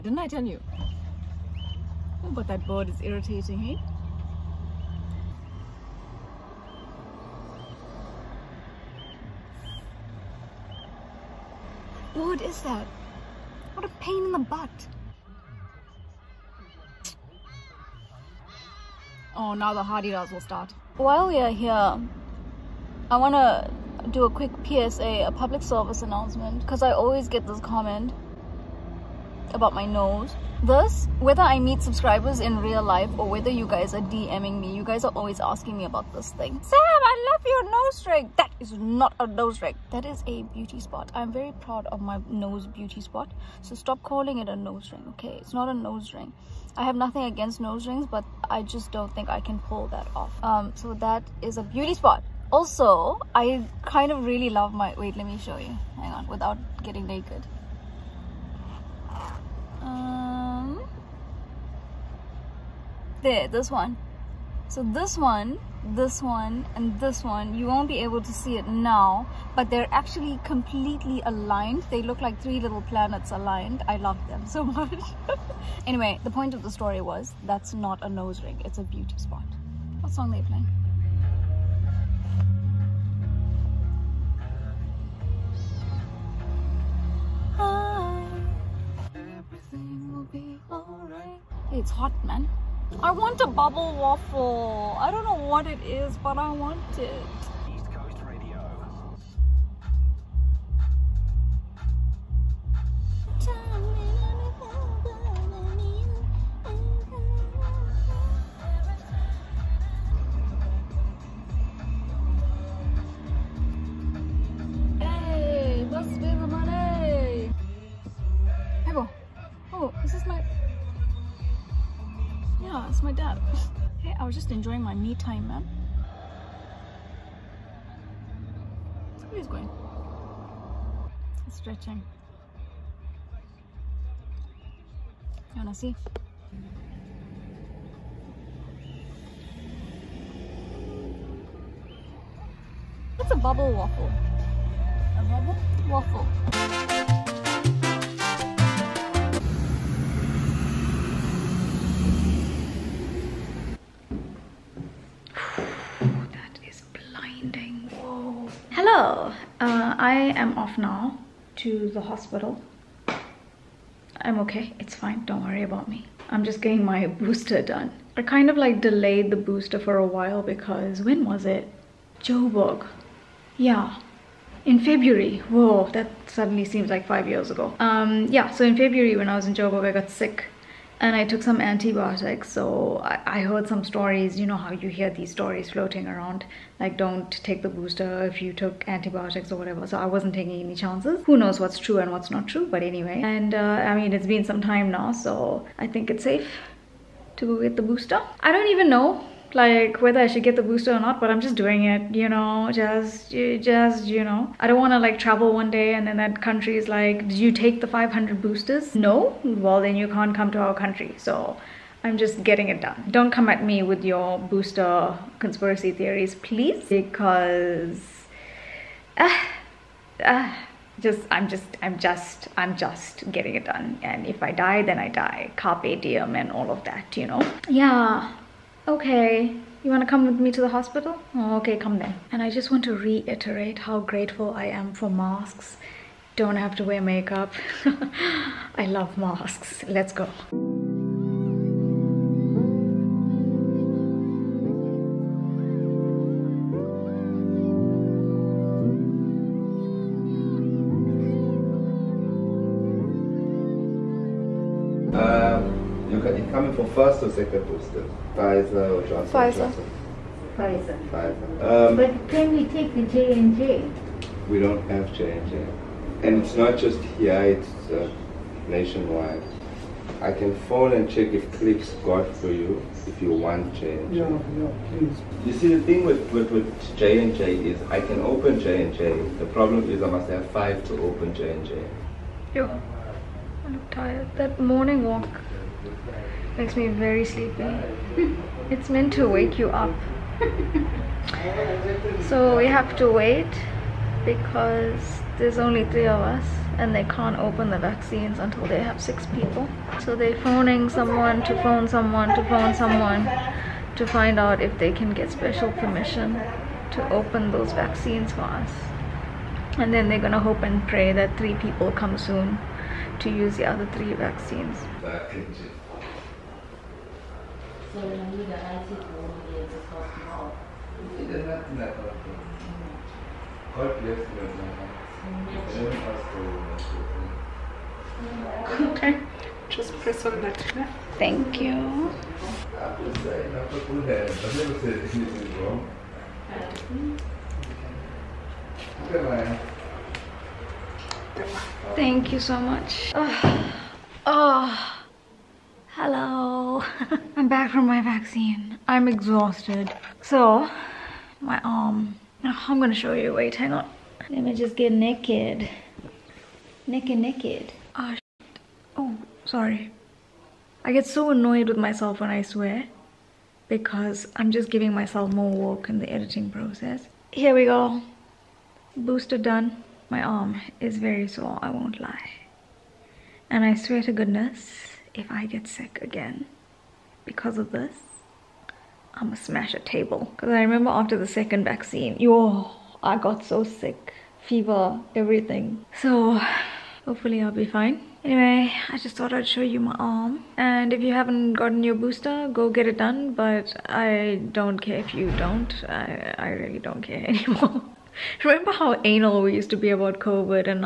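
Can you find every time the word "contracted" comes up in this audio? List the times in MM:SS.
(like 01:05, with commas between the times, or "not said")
not said.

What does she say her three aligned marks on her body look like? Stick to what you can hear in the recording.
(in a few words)
three little planets.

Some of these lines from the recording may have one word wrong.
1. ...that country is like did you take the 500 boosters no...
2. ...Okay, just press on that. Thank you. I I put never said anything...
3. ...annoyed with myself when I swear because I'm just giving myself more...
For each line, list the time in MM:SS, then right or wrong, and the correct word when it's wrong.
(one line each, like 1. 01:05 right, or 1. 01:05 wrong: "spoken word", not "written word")
1. 03:26 right
2. 05:28 right
3. 06:01 right.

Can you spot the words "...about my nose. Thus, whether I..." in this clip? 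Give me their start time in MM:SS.
00:29.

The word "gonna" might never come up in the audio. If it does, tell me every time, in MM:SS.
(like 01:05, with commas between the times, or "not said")
05:10, 05:52, 06:19.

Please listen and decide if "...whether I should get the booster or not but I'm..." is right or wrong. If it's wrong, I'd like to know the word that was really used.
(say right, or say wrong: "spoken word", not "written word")
right.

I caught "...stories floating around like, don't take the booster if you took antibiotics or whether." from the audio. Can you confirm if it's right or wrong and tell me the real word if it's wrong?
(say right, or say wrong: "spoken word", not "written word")
wrong: "whatever", not "whether".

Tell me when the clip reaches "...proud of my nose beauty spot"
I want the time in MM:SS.
00:41.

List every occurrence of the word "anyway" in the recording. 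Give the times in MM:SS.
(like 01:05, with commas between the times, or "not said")
01:15, 03:12, 06:28.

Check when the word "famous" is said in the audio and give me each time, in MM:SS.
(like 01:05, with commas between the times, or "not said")
not said.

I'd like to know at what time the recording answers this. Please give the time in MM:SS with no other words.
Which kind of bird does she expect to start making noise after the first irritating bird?
00:19.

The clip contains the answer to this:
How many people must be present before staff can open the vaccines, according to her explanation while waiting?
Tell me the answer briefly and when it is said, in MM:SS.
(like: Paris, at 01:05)
6, at 04:59.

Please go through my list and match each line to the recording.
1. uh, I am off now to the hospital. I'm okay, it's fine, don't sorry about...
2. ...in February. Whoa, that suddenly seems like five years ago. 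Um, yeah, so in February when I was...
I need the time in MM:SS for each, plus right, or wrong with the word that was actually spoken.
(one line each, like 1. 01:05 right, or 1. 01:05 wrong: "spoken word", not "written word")
1. 02:38 wrong: "worry", not "sorry"
2. 02:54 right.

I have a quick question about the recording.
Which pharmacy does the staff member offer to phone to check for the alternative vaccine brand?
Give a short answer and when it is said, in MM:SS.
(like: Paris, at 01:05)
Clicks, at 04:31.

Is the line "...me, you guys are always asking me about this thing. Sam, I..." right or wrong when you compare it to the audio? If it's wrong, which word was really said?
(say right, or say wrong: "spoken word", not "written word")
right.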